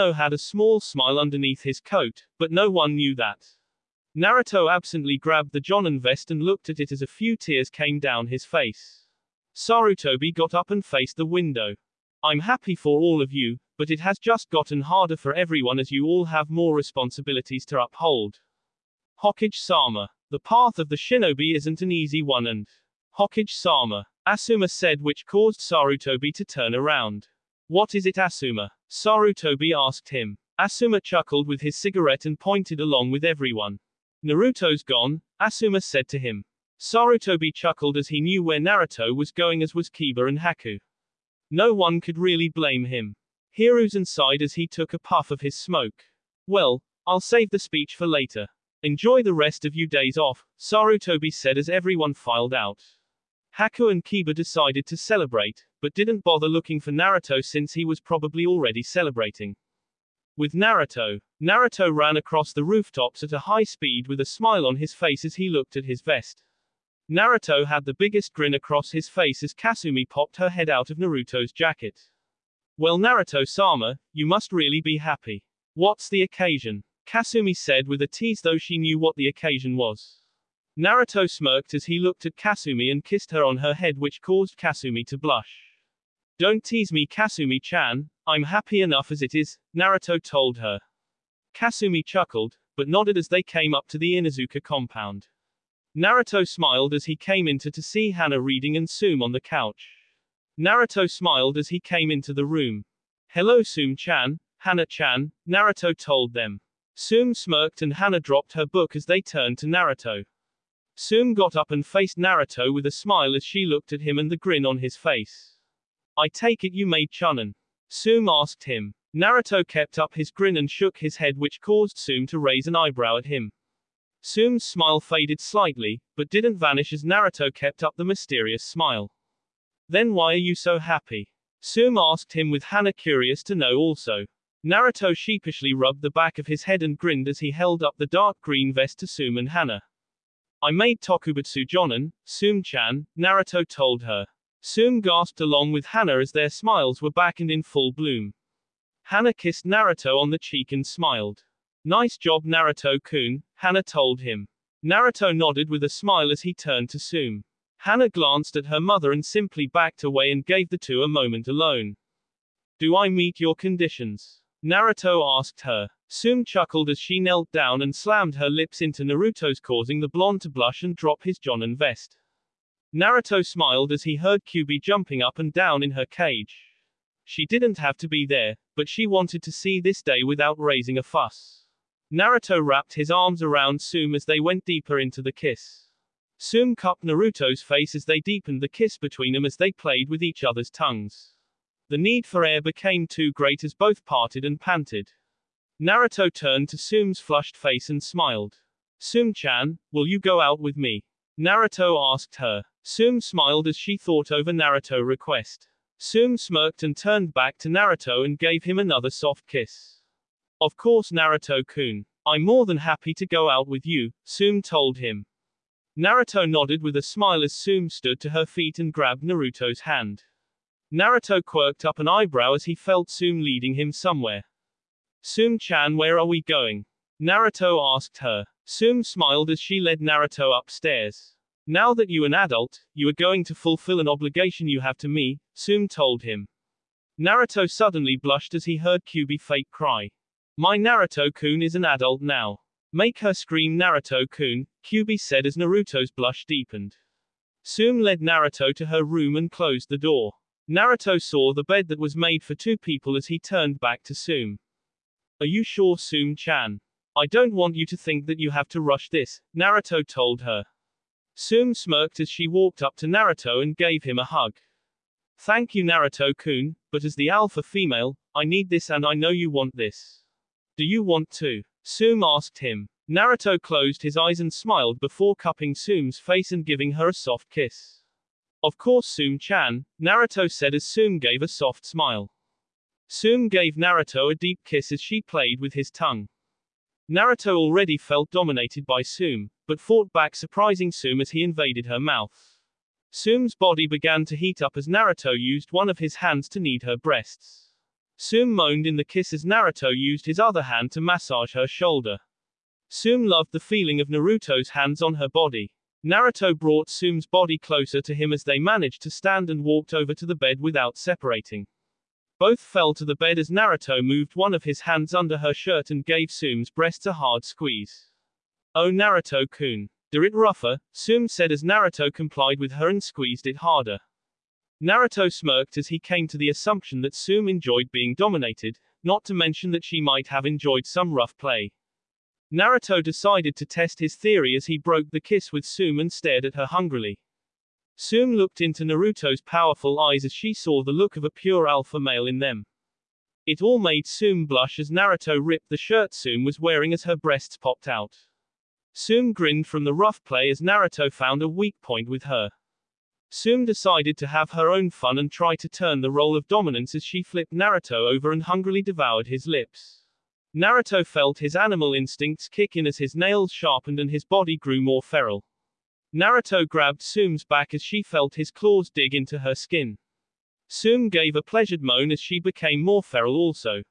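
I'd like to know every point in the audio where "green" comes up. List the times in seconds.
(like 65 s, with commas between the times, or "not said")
138 s.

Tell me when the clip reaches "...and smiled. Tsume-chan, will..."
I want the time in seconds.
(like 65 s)
197 s.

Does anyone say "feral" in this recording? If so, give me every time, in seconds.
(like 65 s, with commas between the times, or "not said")
365 s, 373 s.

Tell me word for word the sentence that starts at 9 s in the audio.
Sarutobi got up and faced the window.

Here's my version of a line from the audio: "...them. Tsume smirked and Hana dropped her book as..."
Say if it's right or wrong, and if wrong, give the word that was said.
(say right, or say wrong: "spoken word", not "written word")
right.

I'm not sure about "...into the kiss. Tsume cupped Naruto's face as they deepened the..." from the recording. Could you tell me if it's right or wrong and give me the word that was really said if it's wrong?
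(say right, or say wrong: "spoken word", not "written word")
right.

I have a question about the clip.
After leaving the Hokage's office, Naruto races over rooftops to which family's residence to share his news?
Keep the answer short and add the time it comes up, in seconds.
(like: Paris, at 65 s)
Inuzuka compound, at 94 s.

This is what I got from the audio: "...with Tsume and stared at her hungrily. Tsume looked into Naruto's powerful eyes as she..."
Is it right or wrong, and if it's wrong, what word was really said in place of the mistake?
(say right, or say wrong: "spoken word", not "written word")
right.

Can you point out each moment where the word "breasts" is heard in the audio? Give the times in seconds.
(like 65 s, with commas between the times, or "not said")
296 s, 316 s, 347 s.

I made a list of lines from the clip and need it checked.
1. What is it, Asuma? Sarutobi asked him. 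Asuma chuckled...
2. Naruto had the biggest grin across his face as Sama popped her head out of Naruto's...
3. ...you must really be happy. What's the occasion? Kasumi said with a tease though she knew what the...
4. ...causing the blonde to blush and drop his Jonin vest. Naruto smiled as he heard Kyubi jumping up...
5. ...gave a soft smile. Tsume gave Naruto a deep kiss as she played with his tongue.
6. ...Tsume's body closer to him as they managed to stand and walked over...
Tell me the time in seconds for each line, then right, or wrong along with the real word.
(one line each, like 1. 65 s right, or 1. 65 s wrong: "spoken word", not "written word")
1. 27 s right
2. 67 s wrong: "Kasumi", not "Sama"
3. 74 s right
4. 169 s right
5. 281 s right
6. 306 s right.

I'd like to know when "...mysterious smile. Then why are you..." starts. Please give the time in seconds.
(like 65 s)
128 s.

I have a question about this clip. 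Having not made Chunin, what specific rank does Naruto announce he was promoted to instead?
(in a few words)
Tokubetsu Jonin.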